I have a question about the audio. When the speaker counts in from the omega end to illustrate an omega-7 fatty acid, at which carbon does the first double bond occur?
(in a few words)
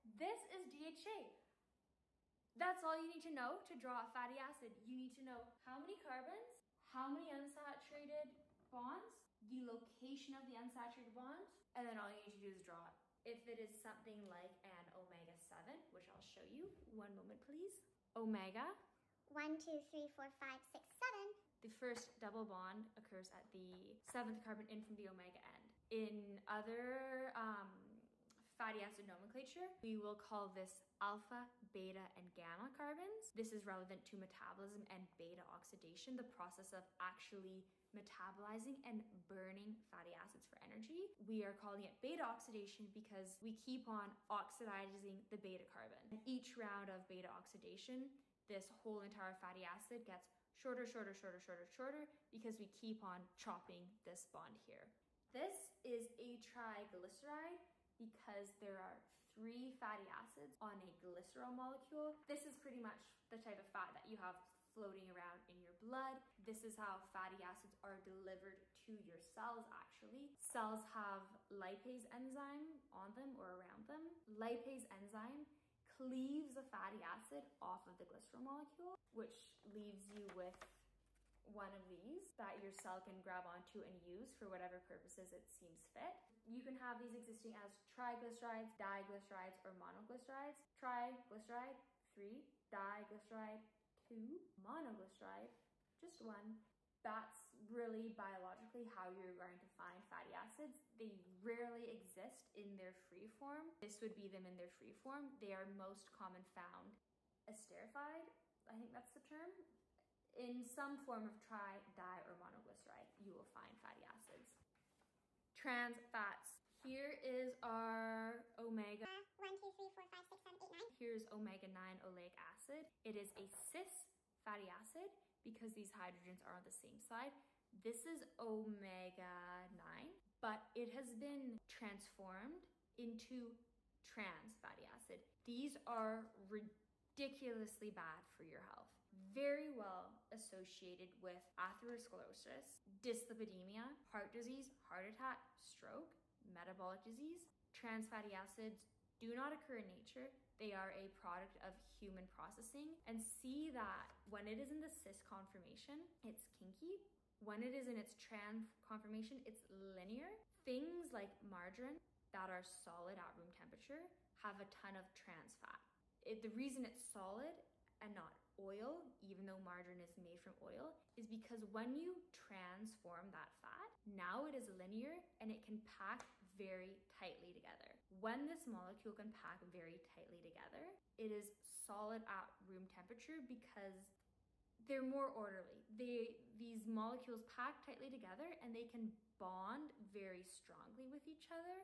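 7th carbon.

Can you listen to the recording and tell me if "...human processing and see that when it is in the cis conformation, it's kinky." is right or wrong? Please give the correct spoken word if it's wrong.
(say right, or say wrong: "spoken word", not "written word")
right.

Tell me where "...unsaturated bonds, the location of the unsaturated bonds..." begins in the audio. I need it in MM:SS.
00:07.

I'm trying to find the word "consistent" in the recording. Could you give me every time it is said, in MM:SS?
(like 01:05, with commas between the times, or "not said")
not said.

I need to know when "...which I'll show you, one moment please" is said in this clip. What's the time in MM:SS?
00:15.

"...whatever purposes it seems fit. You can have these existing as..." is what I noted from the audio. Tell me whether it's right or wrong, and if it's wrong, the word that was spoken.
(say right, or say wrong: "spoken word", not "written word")
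right.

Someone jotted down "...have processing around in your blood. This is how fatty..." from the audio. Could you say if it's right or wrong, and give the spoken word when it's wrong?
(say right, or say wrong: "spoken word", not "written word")
wrong: "floating", not "processing".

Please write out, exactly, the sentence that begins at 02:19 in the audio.
Very well associated with atherosclerosis, dyslipidemia, heart disease, heart attack, stroke, metabolic disease.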